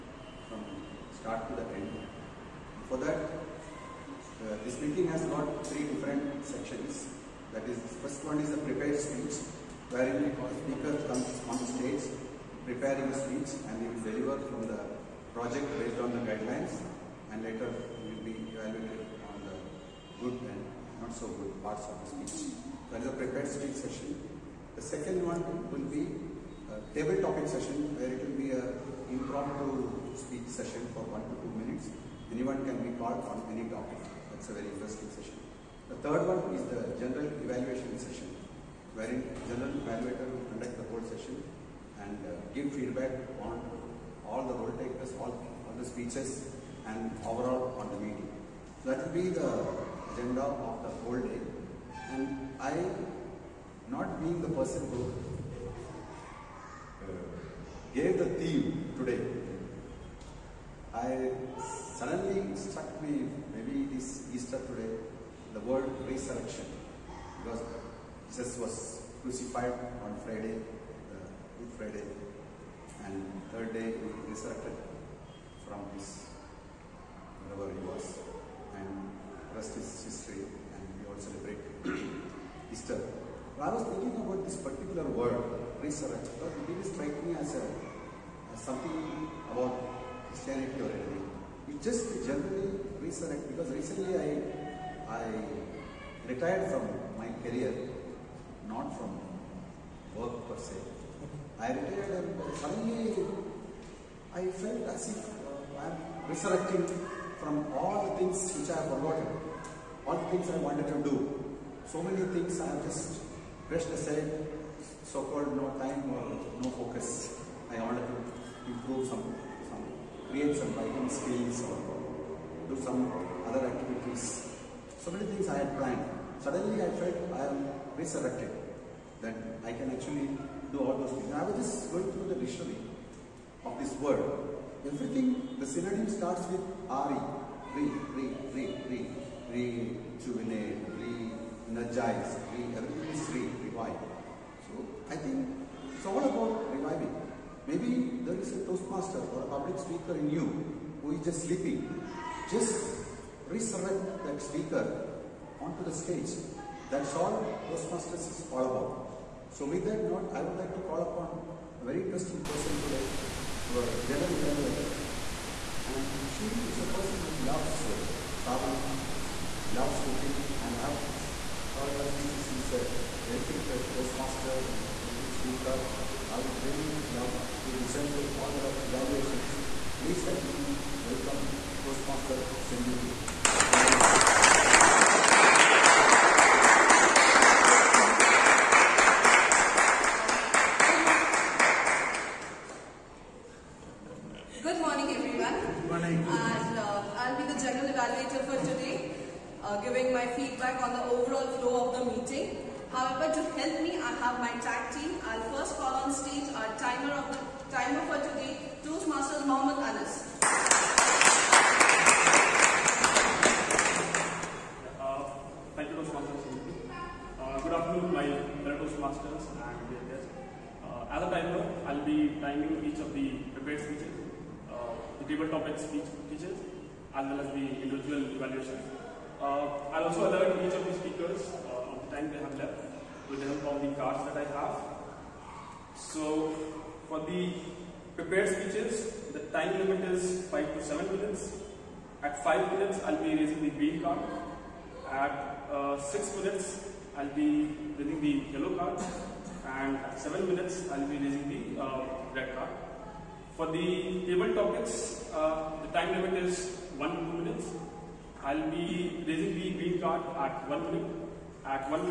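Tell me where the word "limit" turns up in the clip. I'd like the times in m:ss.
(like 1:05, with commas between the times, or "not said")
3:59, 4:16.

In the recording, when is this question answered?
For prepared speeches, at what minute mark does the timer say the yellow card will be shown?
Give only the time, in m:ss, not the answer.
4:05.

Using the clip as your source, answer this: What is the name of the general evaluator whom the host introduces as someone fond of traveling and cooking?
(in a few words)
Senjuti.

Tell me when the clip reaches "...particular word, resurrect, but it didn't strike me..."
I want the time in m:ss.
1:24.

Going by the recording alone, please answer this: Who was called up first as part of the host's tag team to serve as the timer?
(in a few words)
Mohammed Anas.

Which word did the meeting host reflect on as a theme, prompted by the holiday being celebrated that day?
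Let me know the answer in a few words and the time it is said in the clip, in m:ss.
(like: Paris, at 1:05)
Resurrection, at 1:05.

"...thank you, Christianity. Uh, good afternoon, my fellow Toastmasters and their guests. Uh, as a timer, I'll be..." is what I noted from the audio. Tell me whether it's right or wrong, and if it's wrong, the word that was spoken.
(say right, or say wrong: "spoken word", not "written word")
wrong: "Toastmasters", not "Christianity".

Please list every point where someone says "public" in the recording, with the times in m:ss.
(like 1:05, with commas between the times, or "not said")
2:29.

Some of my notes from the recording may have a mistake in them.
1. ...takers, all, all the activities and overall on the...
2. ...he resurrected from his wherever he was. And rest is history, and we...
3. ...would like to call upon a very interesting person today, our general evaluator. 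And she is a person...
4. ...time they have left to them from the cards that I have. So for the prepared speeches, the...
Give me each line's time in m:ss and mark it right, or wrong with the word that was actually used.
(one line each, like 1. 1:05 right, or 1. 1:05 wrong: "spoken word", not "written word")
1. 0:44 wrong: "speeches", not "activities"
2. 1:13 right
3. 2:40 right
4. 3:52 right.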